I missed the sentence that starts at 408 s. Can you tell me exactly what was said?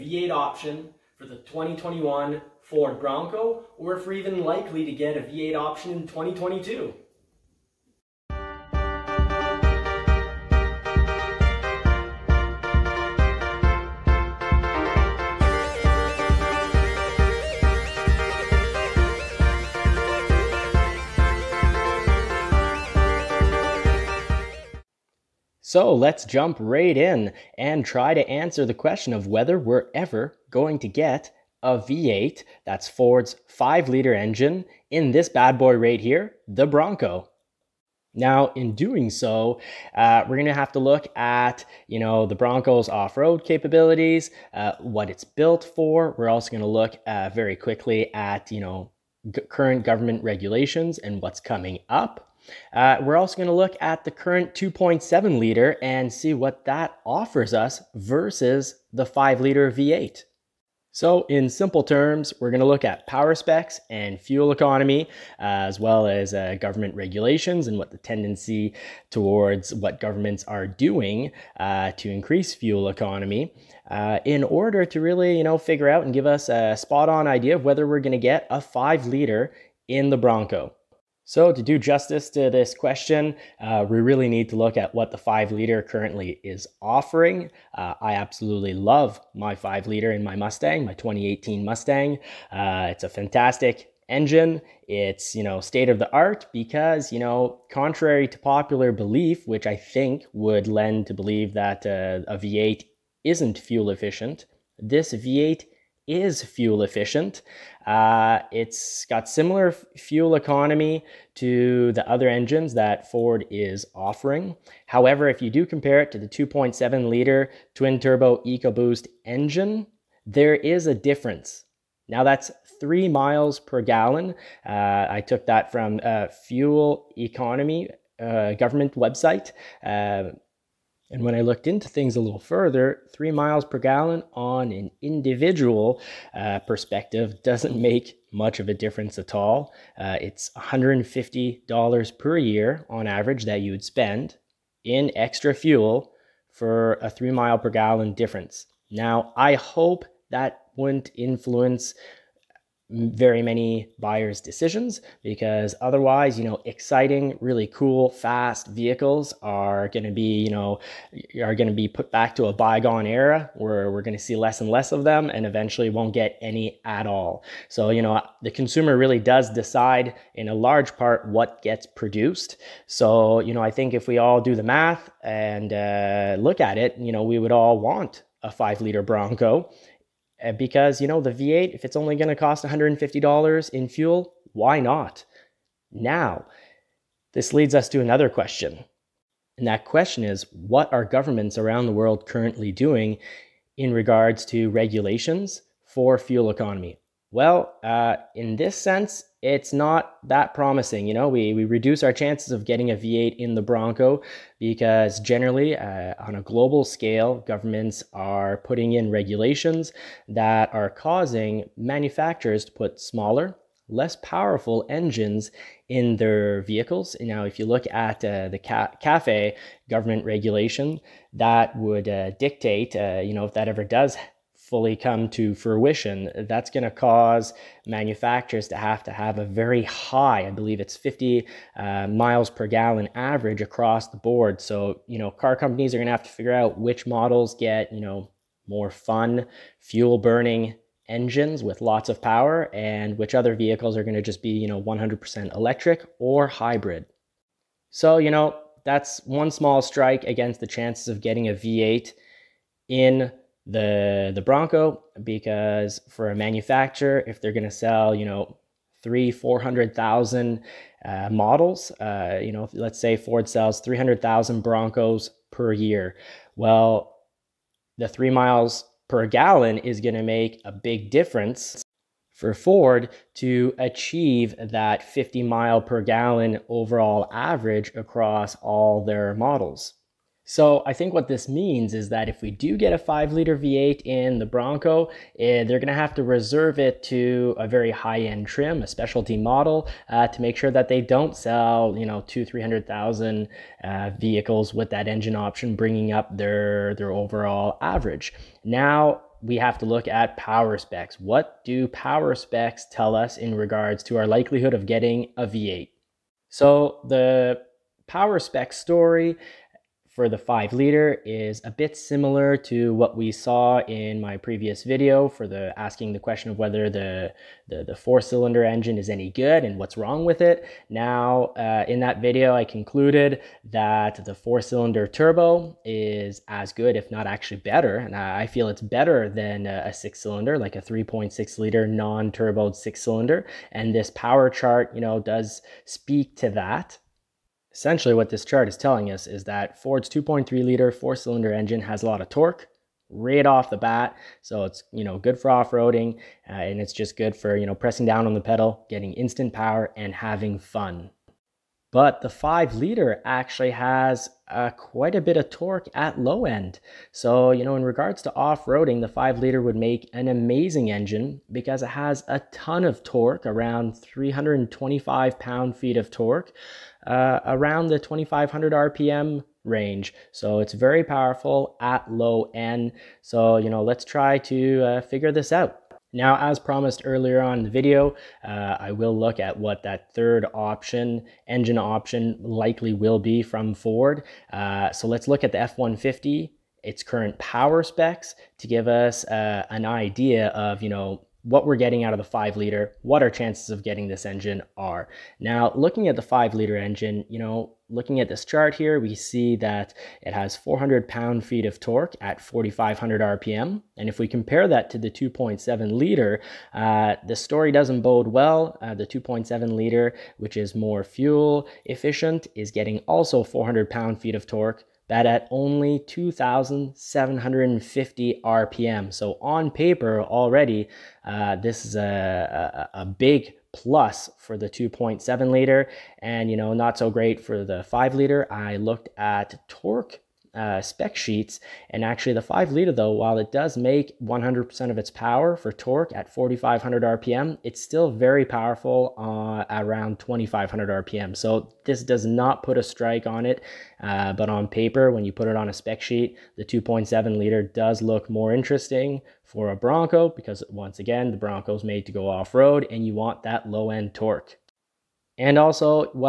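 Uh, the 2.7 liter, which is more fuel efficient, is getting also 400 pound-feet of torque, that at only 2,750 RPM.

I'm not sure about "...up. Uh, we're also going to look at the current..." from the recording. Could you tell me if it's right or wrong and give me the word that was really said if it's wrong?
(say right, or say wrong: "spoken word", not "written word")
right.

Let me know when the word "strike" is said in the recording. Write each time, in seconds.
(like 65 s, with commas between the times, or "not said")
249 s, 442 s.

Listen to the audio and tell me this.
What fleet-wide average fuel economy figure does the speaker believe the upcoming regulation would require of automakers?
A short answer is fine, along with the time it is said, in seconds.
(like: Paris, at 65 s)
50 miles per gallon, at 230 s.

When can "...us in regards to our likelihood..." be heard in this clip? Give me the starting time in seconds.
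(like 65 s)
303 s.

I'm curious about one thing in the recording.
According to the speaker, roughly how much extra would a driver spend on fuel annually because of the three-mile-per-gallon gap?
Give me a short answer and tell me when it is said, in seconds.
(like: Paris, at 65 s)
$150, at 140 s.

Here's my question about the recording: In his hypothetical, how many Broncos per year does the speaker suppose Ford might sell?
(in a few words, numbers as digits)
300,000.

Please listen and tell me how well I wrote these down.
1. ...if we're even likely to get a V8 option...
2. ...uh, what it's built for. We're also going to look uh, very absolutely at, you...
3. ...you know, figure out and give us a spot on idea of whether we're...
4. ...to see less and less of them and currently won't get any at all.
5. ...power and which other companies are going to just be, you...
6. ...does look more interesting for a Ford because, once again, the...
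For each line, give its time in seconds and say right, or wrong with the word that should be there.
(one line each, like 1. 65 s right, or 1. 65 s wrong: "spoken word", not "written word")
1. 3 s right
2. 44 s wrong: "quickly", not "absolutely"
3. 75 s right
4. 164 s wrong: "eventually", not "currently"
5. 242 s wrong: "vehicles", not "companies"
6. 447 s wrong: "Bronco", not "Ford".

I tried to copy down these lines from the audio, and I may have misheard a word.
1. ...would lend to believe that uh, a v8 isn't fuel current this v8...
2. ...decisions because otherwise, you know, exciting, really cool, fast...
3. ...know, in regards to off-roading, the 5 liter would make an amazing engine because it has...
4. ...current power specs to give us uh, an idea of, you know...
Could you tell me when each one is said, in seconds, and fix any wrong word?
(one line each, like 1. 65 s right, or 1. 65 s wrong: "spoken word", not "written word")
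1. 100 s wrong: "efficient", not "current"
2. 154 s right
3. 357 s right
4. 387 s right.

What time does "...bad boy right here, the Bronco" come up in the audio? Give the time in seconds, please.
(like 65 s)
35 s.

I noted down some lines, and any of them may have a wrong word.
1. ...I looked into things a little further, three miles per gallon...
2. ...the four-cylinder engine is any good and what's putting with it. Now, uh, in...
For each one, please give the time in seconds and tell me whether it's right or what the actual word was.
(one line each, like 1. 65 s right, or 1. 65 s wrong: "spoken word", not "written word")
1. 131 s right
2. 317 s wrong: "wrong", not "putting".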